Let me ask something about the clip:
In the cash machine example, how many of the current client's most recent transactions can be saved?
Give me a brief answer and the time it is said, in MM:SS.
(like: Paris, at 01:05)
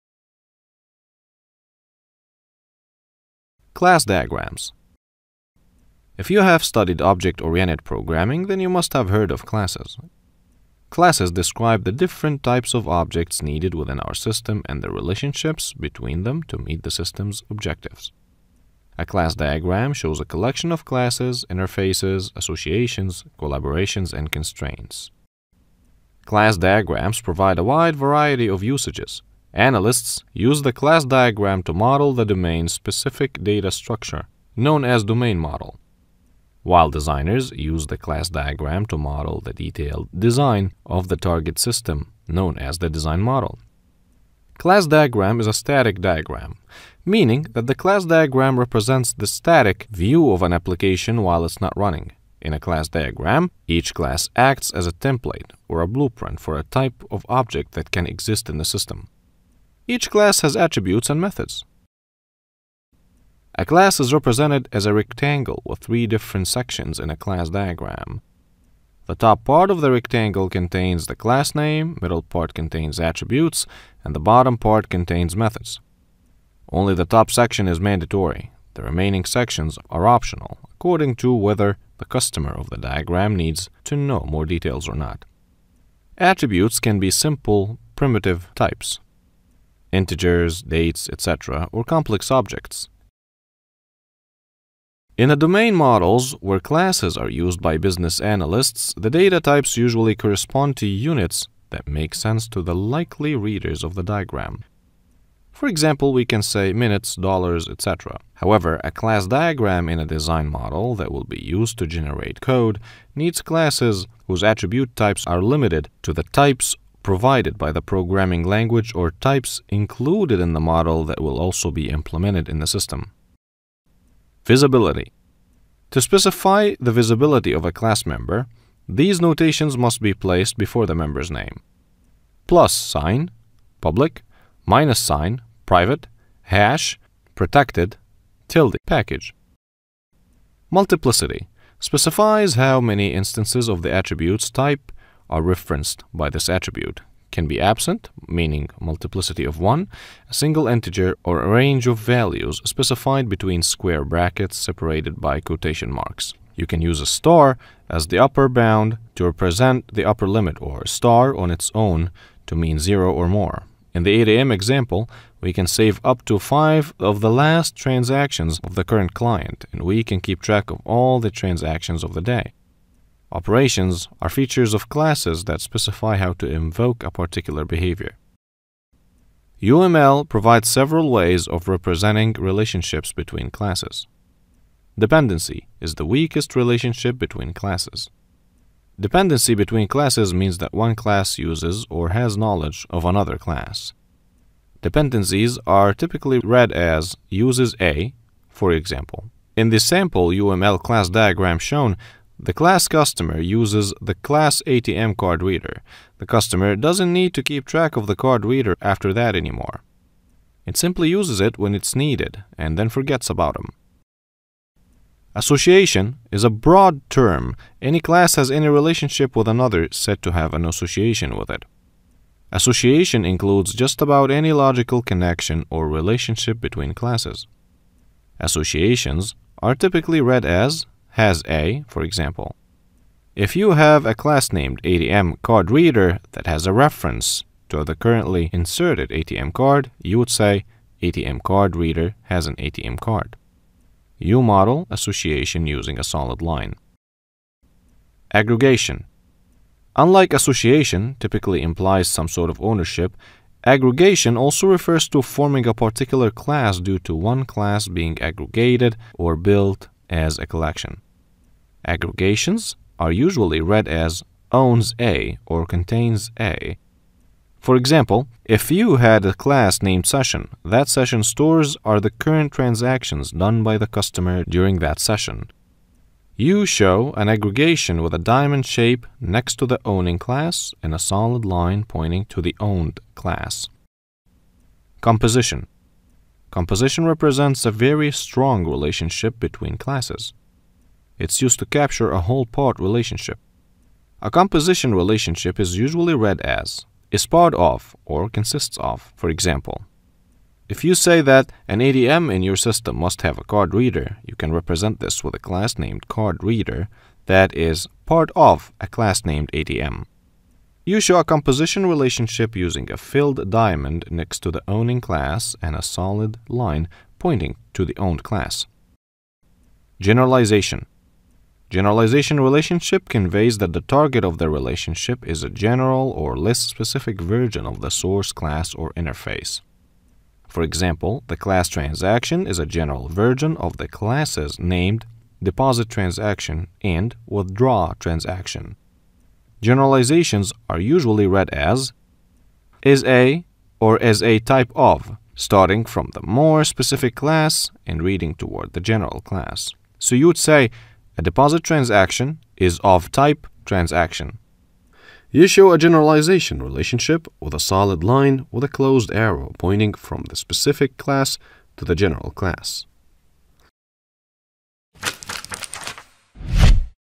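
5, at 02:46.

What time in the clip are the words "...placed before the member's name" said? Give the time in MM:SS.
02:10.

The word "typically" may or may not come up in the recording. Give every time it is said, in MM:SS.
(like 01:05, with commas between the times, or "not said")
03:15, 03:49, 04:11.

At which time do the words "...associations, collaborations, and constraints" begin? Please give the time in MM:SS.
00:22.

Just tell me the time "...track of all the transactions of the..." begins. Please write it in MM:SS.
02:50.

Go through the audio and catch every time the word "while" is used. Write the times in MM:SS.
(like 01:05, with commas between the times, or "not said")
00:36, 00:51.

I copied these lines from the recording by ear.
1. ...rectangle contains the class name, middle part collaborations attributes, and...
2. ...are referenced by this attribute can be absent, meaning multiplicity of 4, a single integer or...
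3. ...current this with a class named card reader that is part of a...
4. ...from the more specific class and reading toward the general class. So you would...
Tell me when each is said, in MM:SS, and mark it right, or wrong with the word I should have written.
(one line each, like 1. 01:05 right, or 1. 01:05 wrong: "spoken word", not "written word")
1. 01:09 wrong: "contains", not "collaborations"
2. 02:25 wrong: "1", not "4"
3. 05:04 wrong: "represent", not "current"
4. 05:45 right.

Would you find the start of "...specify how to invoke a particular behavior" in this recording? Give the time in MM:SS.
02:55.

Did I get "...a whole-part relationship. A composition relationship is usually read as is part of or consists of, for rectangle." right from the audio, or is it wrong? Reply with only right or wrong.
wrong.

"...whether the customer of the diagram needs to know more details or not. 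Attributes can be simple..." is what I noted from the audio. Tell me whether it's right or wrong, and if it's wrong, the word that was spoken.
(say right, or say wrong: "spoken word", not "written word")
right.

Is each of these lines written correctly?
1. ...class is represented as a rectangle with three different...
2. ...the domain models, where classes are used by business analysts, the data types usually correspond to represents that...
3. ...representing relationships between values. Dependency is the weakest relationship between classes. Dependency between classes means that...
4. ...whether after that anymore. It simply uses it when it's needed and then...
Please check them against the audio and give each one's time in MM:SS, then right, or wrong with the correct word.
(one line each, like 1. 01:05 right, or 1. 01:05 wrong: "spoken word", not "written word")
1. 01:03 right
2. 01:35 wrong: "units", not "represents"
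3. 03:01 wrong: "classes", not "values"
4. 03:28 wrong: "reader", not "whether".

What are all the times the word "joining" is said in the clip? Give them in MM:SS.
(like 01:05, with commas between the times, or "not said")
not said.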